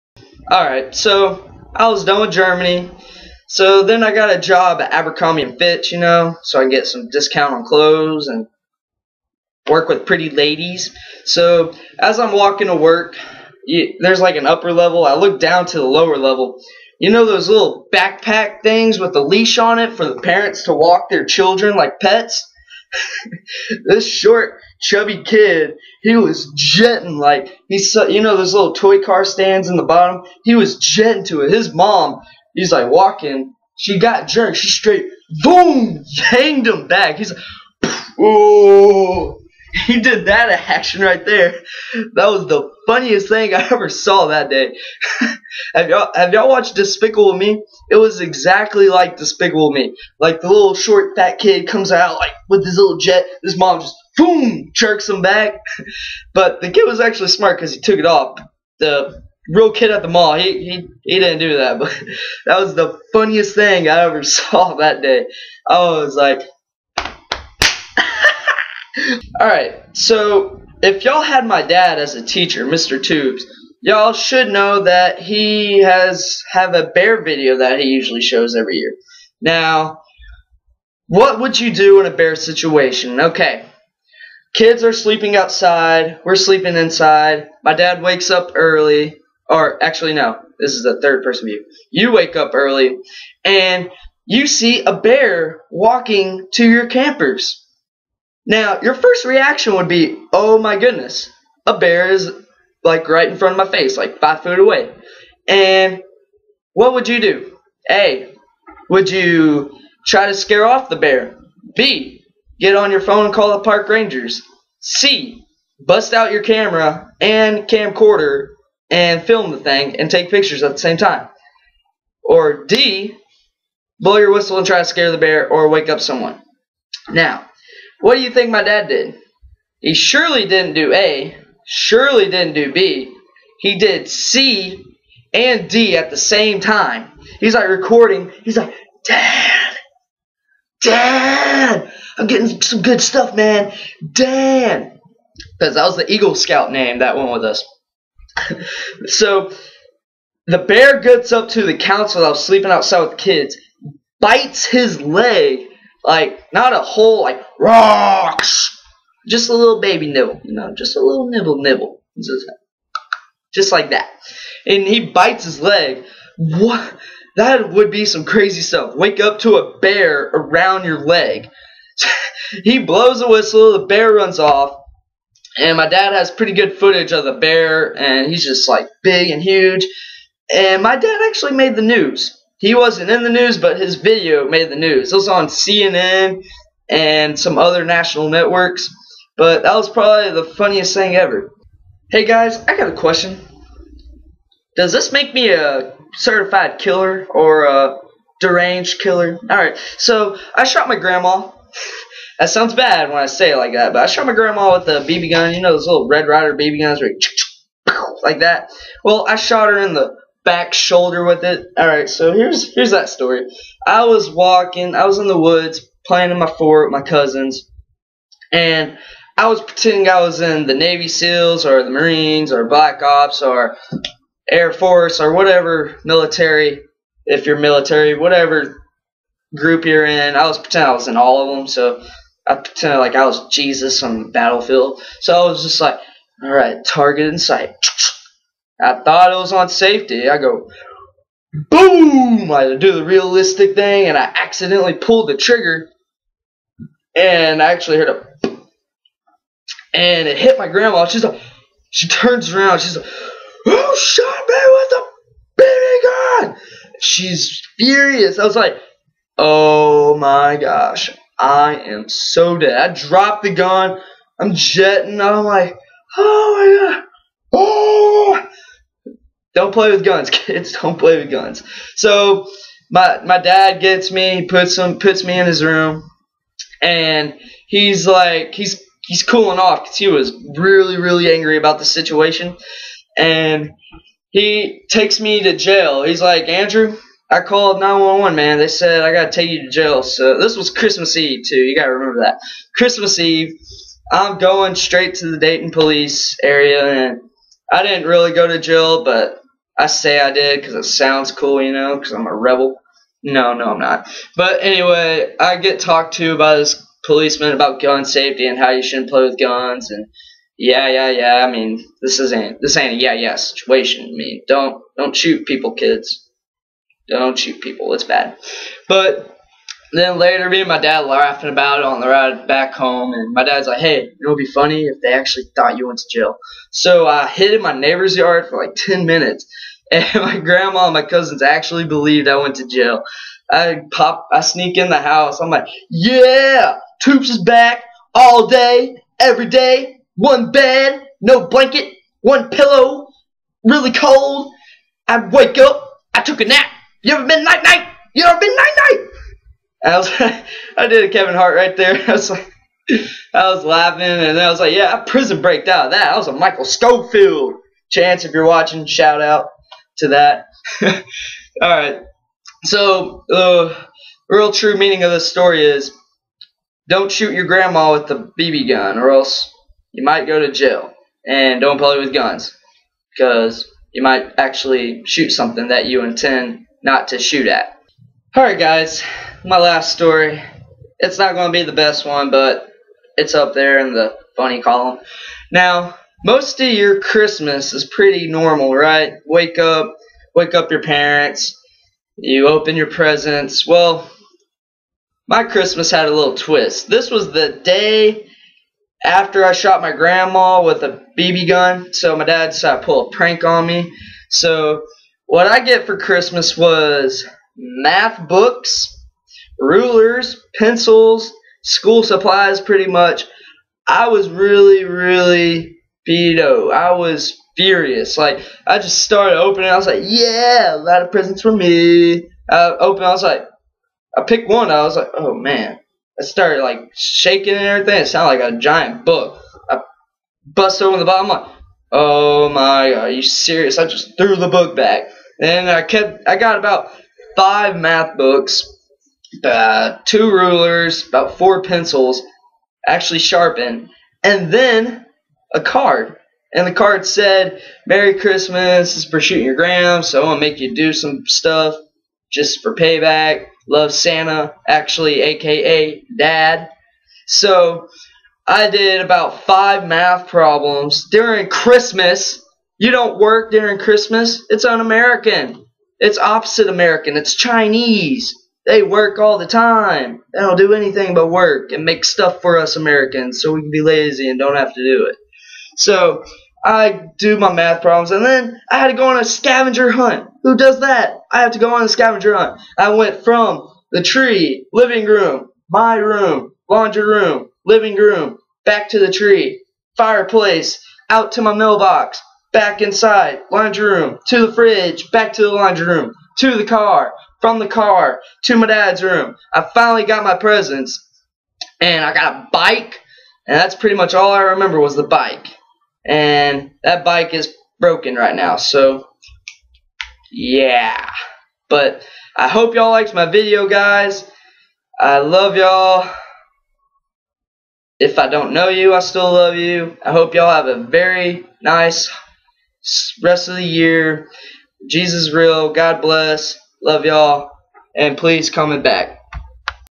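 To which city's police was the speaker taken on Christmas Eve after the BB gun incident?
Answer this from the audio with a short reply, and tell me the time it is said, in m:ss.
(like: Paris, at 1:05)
Dayton, at 4:55.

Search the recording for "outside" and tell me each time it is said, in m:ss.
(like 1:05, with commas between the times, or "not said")
1:25, 2:32.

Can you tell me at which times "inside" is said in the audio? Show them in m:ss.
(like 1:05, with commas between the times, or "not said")
1:26, 8:12.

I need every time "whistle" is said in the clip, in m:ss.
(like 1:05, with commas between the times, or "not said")
2:04, 2:53.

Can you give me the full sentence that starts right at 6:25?
Now, most of your Christmas is pretty normal, right?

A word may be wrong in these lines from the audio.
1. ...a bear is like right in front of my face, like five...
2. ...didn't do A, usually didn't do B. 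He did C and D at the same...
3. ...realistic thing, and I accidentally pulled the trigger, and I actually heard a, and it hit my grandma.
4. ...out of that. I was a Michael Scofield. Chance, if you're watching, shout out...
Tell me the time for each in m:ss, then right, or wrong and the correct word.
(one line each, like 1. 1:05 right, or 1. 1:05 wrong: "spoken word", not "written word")
1. 1:41 right
2. 2:10 wrong: "surely", not "usually"
3. 4:03 right
4. 5:55 right.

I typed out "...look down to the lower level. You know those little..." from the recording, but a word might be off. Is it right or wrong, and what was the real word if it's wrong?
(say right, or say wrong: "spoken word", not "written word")
right.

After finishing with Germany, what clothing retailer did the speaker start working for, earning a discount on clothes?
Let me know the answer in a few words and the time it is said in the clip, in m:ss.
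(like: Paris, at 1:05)
Abercrombie and Fitch, at 0:04.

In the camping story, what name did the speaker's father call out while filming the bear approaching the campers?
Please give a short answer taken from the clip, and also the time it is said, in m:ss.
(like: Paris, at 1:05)
Dan, at 2:24.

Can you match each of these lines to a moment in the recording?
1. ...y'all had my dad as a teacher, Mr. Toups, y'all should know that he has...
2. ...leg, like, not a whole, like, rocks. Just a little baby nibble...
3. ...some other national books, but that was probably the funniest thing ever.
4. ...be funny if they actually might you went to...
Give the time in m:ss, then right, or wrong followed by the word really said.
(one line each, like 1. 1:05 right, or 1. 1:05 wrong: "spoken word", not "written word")
1. 1:11 right
2. 2:35 right
3. 3:07 wrong: "networks", not "books"
4. 5:24 wrong: "thought", not "might".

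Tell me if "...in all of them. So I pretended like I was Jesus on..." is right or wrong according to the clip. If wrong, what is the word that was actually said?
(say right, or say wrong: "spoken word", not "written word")
right.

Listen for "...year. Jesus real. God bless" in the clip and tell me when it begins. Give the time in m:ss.
8:43.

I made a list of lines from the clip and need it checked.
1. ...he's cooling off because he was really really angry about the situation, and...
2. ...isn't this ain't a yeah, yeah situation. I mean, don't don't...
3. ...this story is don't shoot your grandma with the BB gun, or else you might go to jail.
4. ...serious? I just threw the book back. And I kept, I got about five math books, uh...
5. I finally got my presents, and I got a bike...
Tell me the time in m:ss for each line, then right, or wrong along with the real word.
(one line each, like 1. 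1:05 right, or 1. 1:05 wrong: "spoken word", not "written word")
1. 4:39 right
2. 5:12 right
3. 6:05 right
4. 7:13 right
5. 8:19 right.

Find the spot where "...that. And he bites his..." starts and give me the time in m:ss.
2:43.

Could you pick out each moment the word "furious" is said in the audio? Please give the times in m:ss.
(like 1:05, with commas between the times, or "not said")
4:17, 6:57.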